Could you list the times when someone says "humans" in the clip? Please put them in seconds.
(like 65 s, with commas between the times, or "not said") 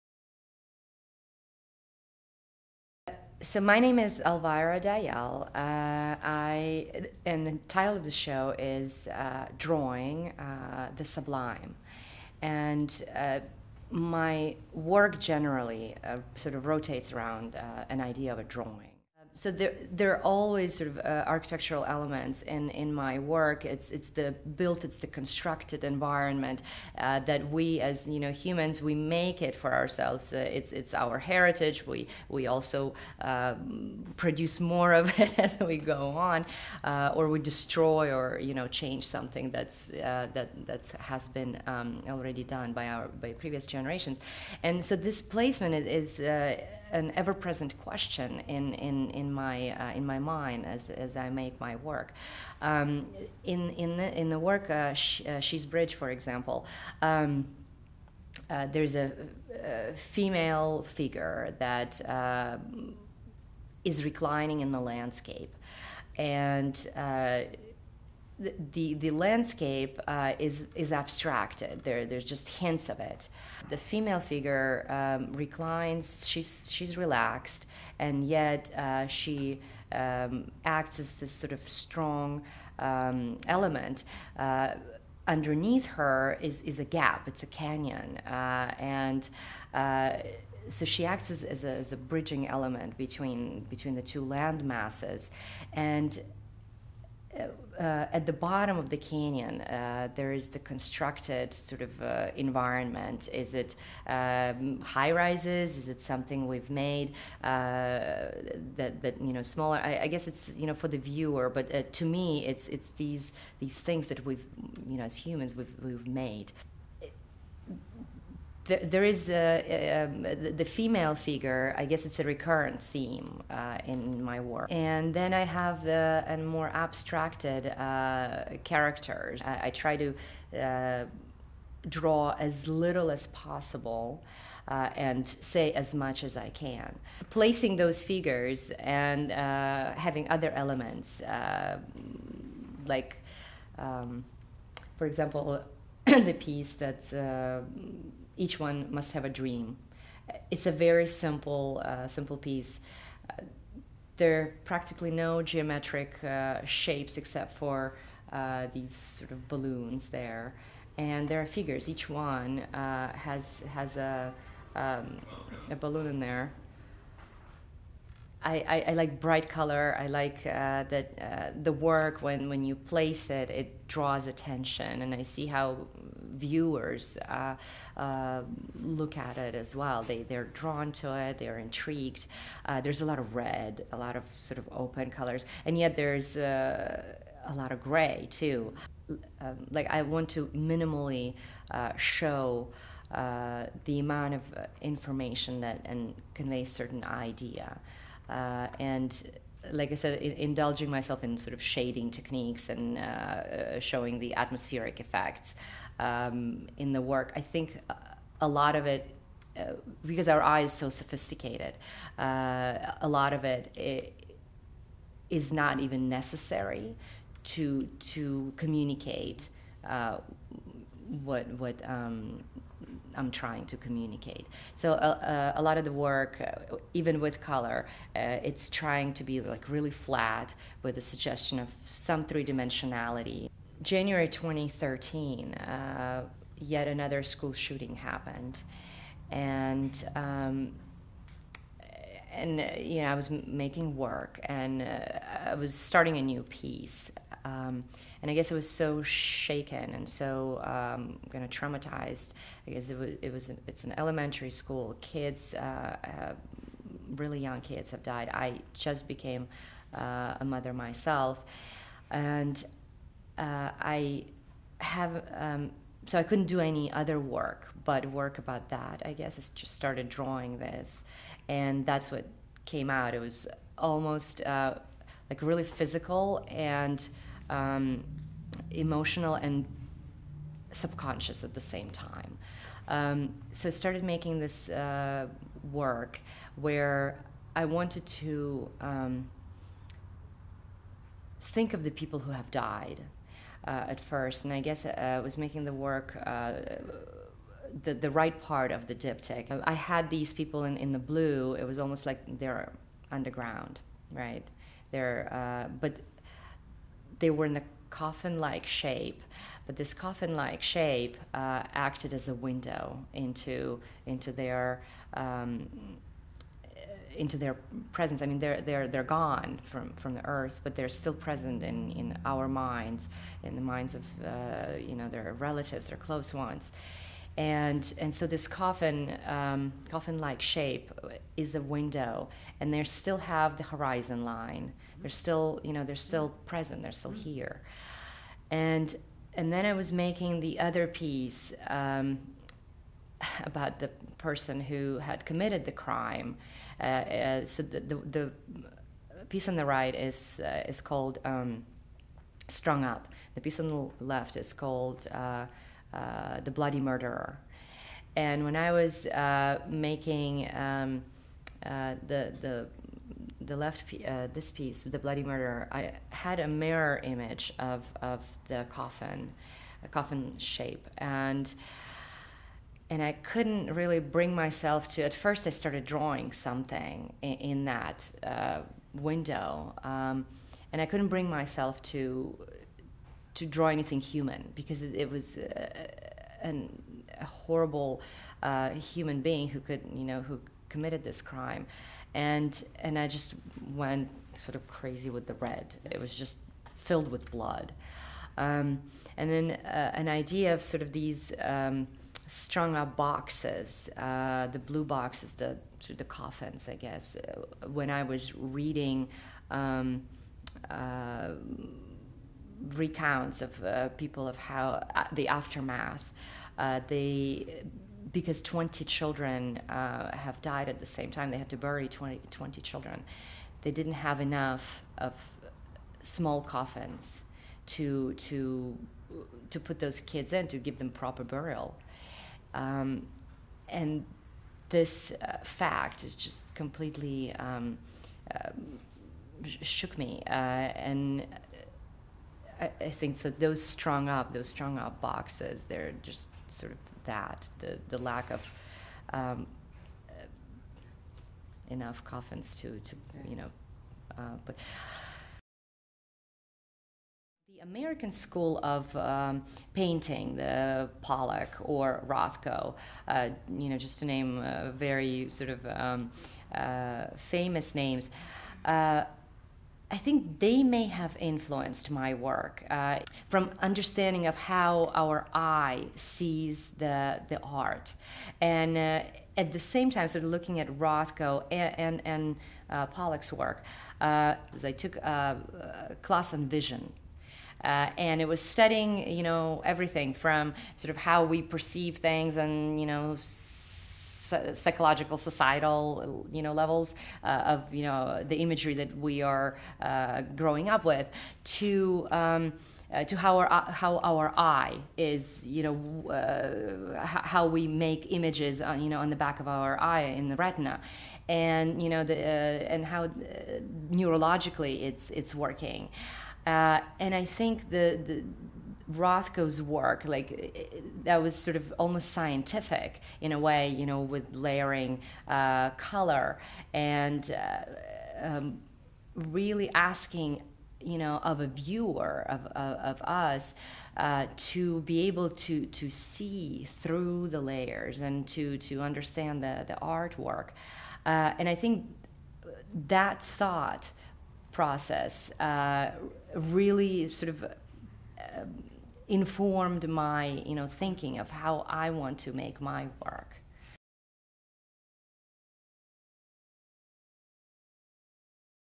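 28 s, 115 s, 384 s, 388 s.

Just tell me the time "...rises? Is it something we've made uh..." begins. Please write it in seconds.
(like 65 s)
105 s.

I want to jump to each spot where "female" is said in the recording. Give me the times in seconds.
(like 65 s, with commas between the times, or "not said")
59 s, 73 s, 120 s.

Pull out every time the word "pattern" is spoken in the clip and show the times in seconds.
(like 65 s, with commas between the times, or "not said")
not said.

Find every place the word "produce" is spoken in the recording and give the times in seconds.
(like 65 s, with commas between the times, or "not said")
34 s.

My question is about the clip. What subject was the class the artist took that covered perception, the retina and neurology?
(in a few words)
vision.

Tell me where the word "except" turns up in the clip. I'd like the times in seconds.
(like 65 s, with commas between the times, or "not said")
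157 s.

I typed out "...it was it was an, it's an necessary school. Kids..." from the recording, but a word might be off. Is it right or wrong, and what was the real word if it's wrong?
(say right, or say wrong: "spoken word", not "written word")
wrong: "elementary", not "necessary".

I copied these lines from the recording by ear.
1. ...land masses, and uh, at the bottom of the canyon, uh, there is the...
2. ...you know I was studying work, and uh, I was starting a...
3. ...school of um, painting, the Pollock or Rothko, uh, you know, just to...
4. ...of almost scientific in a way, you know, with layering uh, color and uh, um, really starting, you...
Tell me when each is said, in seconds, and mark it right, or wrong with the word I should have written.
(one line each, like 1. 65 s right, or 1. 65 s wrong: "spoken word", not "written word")
1. 94 s right
2. 242 s wrong: "making", not "studying"
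3. 458 s right
4. 521 s wrong: "asking", not "starting".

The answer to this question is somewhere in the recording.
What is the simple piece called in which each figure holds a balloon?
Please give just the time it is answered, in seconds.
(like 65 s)
148 s.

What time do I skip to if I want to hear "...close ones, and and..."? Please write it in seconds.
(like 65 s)
325 s.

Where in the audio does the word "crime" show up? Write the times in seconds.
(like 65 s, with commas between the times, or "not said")
345 s, 391 s.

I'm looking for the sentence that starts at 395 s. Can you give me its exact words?
It was just filled with blood.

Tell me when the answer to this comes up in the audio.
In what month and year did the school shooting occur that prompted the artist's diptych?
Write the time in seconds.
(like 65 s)
233 s.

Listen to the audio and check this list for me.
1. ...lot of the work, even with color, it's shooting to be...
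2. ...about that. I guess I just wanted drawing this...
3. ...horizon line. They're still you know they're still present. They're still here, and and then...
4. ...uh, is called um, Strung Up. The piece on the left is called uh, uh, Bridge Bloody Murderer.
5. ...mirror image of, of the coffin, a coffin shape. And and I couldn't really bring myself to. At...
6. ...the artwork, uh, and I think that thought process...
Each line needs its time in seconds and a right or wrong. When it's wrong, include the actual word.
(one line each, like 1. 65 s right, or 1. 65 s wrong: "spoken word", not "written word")
1. 225 s wrong: "trying", not "shooting"
2. 268 s wrong: "started", not "wanted"
3. 333 s right
4. 350 s wrong: "The", not "Bridge"
5. 366 s right
6. 539 s right.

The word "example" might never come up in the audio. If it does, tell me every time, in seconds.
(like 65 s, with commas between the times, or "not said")
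56 s, 145 s.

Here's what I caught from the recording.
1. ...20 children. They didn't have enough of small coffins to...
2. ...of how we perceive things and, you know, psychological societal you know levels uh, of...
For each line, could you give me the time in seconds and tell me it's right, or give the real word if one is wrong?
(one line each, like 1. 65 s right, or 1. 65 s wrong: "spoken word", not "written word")
1. 422 s right
2. 490 s right.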